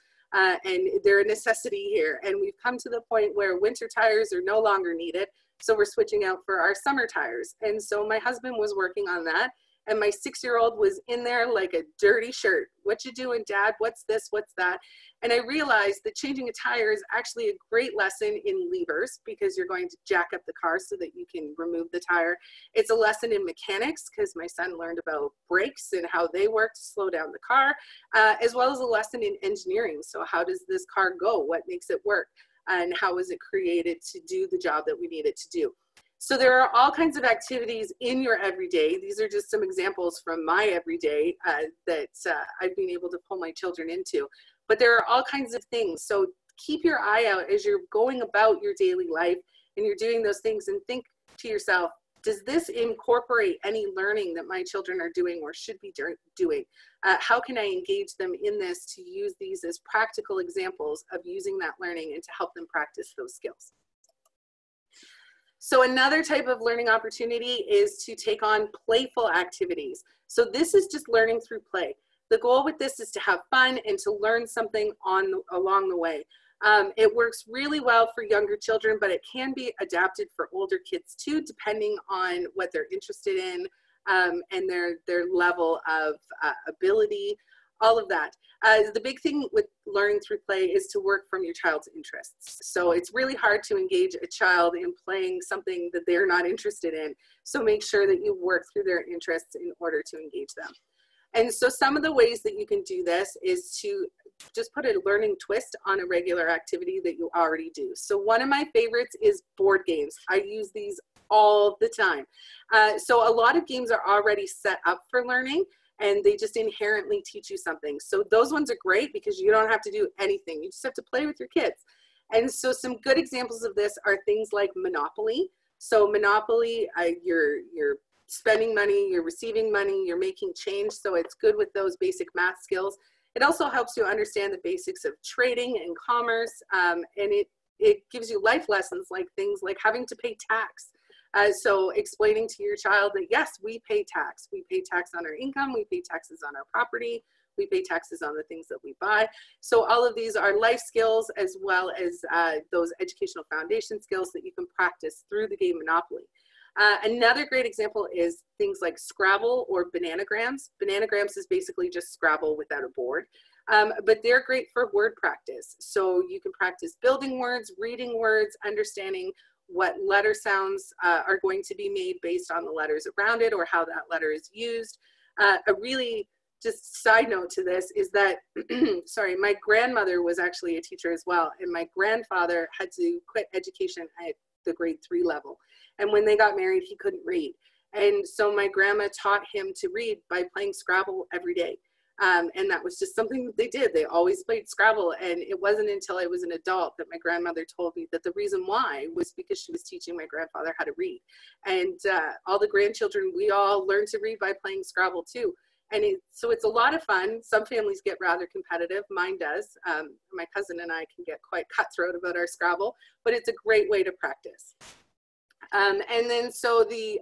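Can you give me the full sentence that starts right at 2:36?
Uh, another great example is things like Scrabble or Bananagrams.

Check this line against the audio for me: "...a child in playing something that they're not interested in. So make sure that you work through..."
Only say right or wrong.
right.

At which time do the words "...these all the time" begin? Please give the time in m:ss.
1:50.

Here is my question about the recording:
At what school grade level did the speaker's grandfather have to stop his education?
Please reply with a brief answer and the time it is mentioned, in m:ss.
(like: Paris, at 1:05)
grade 3, at 3:04.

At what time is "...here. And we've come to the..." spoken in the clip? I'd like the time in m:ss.
0:01.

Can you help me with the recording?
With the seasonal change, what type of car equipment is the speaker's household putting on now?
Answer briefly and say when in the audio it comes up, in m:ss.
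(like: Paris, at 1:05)
summer tires, at 0:06.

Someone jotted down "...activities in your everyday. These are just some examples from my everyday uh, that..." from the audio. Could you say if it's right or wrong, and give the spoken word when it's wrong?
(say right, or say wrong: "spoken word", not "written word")
right.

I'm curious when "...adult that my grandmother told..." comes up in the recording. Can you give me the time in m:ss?
3:16.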